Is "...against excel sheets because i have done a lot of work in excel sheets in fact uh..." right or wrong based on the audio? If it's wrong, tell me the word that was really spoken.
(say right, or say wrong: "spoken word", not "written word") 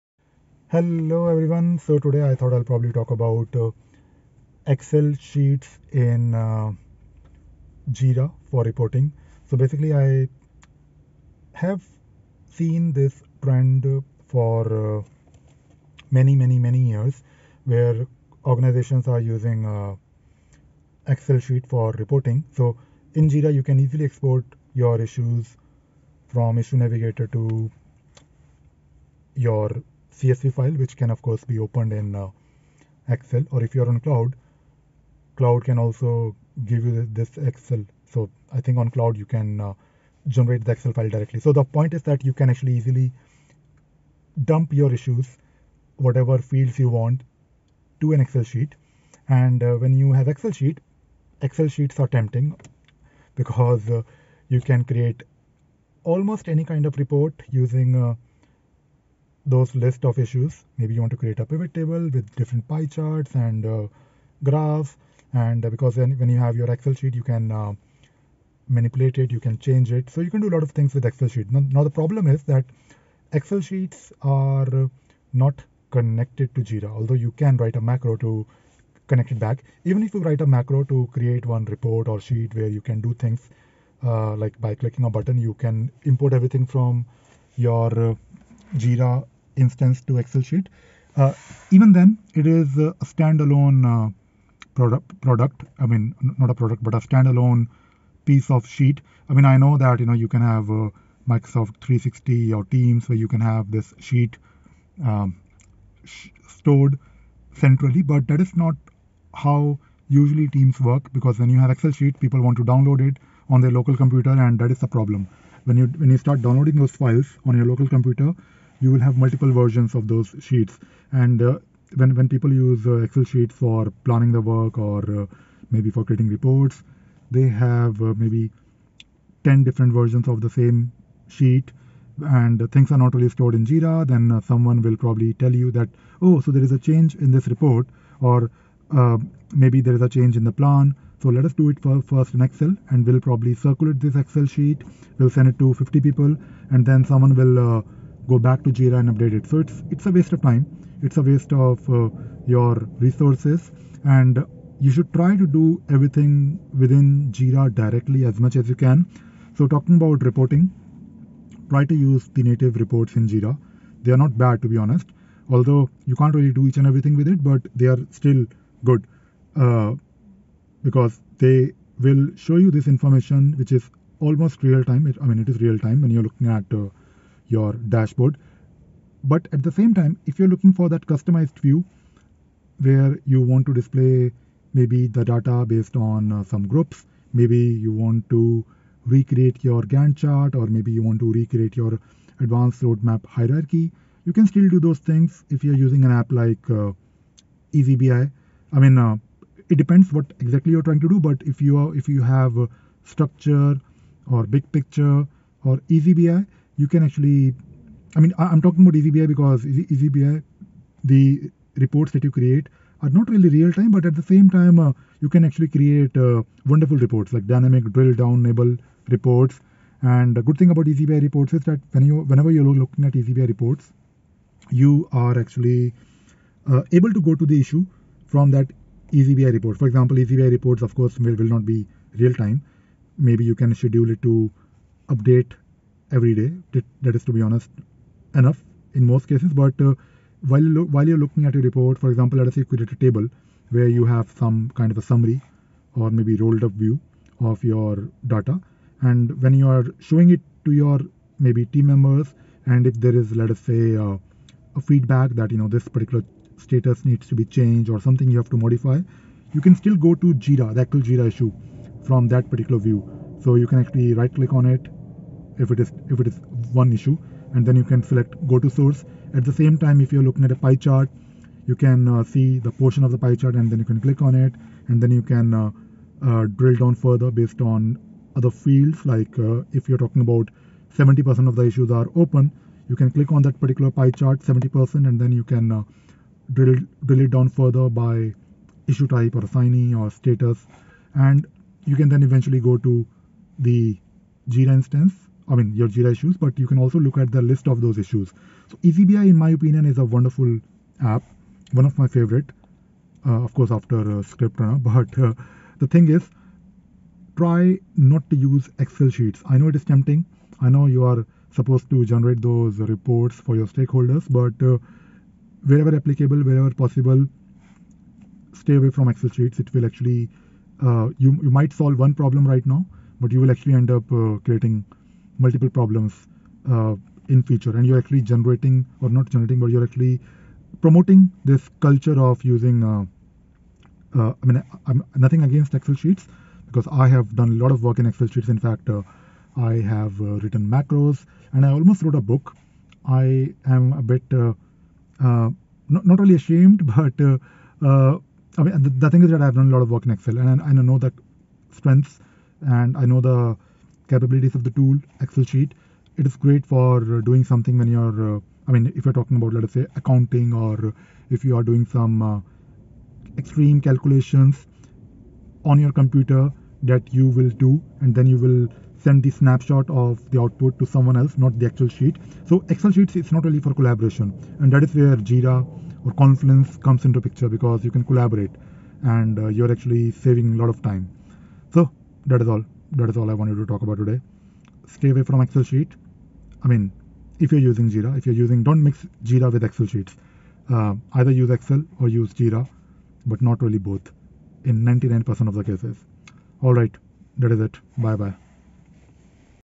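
right.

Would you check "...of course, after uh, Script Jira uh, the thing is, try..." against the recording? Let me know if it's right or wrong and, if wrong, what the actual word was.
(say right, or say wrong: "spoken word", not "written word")
wrong: "But", not "Jira".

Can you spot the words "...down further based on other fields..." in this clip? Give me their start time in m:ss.
4:36.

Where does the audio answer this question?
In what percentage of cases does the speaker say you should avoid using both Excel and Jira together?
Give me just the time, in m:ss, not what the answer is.
6:34.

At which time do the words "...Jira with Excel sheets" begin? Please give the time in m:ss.
6:29.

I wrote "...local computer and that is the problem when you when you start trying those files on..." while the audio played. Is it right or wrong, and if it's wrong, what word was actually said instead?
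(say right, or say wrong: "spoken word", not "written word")
wrong: "downloading", not "trying".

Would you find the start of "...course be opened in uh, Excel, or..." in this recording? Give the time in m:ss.
0:31.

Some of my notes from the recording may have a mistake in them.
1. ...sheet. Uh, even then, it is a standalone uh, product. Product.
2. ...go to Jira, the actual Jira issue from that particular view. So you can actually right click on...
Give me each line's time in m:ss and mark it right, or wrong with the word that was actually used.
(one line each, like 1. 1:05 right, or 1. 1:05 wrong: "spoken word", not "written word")
1. 1:30 right
2. 4:19 right.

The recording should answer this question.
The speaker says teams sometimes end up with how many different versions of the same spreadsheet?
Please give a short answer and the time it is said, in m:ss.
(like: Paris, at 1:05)
10, at 2:09.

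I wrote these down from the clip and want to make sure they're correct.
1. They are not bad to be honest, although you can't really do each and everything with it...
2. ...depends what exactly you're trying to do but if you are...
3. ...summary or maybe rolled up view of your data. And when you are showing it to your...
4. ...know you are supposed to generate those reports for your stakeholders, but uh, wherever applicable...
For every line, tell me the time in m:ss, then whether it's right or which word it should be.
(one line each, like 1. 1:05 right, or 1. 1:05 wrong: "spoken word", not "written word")
1. 2:44 right
2. 3:19 right
3. 4:05 right
4. 5:10 right.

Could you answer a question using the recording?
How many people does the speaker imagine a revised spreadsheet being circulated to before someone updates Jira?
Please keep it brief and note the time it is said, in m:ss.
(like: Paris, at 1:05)
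50, at 2:25.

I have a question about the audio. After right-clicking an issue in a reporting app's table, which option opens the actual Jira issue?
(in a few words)
go to source.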